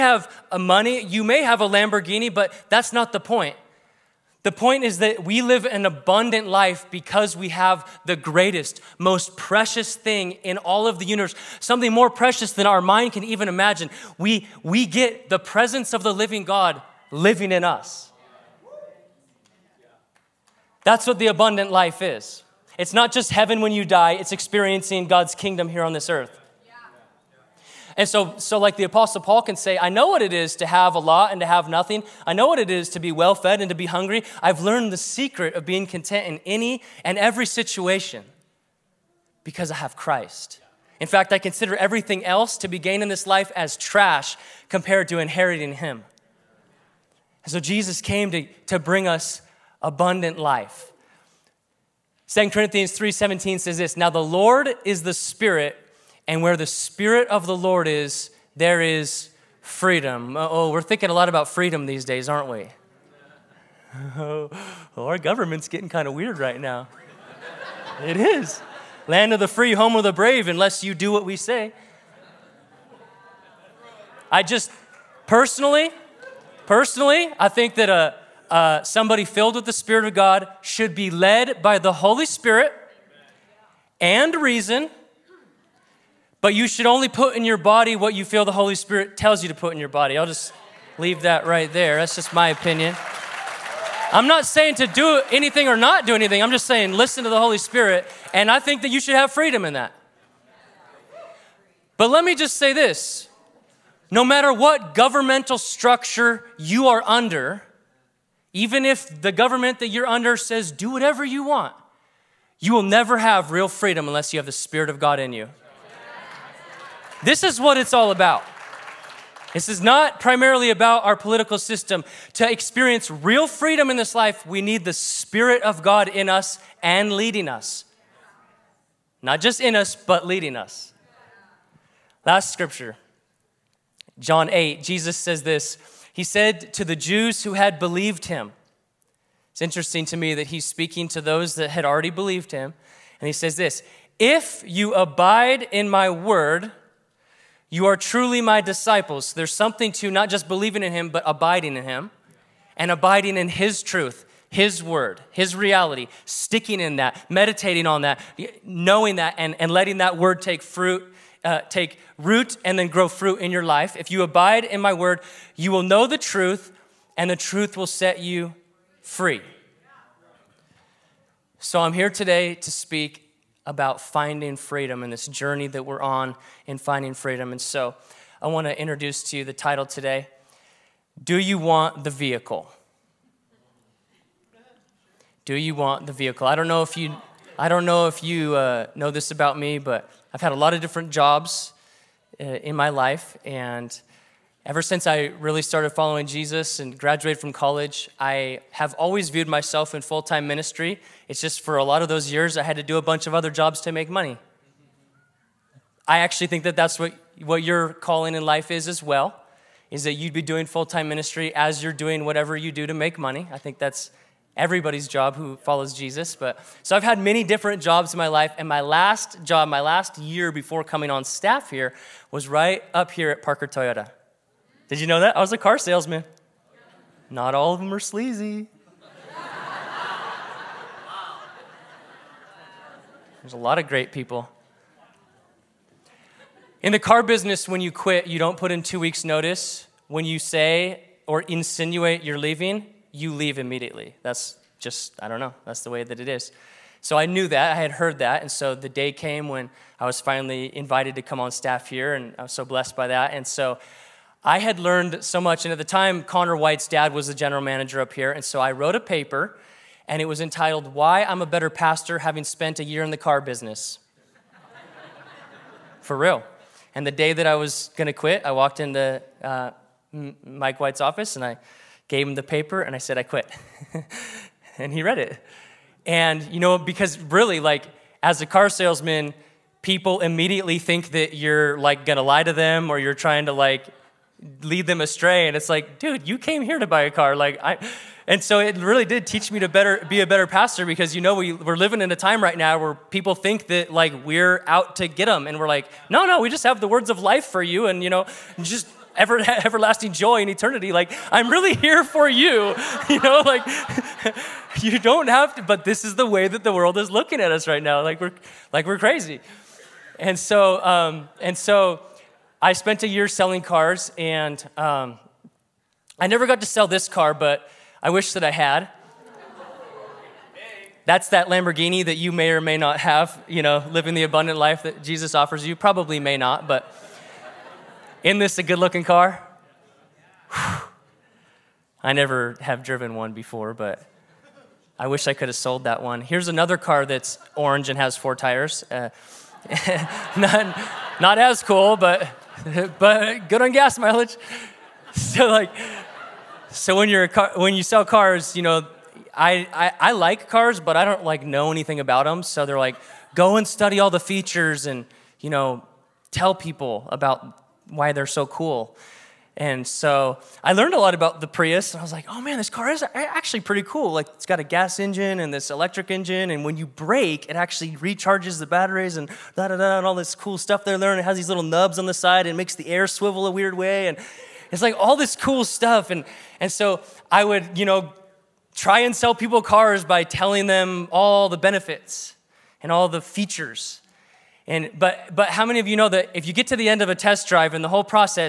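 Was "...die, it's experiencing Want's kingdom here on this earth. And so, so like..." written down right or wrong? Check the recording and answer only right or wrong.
wrong.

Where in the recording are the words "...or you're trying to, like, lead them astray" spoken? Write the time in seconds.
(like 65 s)
282 s.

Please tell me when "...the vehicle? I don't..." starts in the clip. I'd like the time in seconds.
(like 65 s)
186 s.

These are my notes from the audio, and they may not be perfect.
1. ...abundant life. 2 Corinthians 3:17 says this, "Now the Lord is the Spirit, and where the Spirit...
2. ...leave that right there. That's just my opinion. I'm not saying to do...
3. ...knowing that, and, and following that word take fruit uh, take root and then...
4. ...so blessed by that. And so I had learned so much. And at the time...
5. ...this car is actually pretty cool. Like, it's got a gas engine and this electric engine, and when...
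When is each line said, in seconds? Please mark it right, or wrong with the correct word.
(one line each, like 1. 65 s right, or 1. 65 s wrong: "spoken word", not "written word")
1. 49 s right
2. 90 s right
3. 158 s wrong: "letting", not "following"
4. 252 s right
5. 362 s right.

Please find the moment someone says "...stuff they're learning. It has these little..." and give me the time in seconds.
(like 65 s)
370 s.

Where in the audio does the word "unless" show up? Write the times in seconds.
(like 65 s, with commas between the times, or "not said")
70 s, 114 s.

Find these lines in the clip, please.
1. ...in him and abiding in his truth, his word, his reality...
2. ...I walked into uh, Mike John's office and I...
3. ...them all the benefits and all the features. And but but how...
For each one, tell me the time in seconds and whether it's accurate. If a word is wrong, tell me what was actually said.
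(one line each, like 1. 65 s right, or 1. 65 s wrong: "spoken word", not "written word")
1. 151 s right
2. 268 s wrong: "White", not "John"
3. 380 s right.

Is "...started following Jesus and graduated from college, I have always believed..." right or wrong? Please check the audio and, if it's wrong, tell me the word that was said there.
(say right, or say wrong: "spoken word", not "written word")
wrong: "viewed", not "believed".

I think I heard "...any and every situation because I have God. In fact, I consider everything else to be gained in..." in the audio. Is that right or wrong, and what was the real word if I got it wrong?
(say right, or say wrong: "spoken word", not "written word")
wrong: "Christ", not "God".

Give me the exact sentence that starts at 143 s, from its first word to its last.
And he says this If you abide in my word, you are truly my disciples.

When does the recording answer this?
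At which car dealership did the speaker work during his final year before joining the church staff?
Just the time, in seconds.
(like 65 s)
223 s.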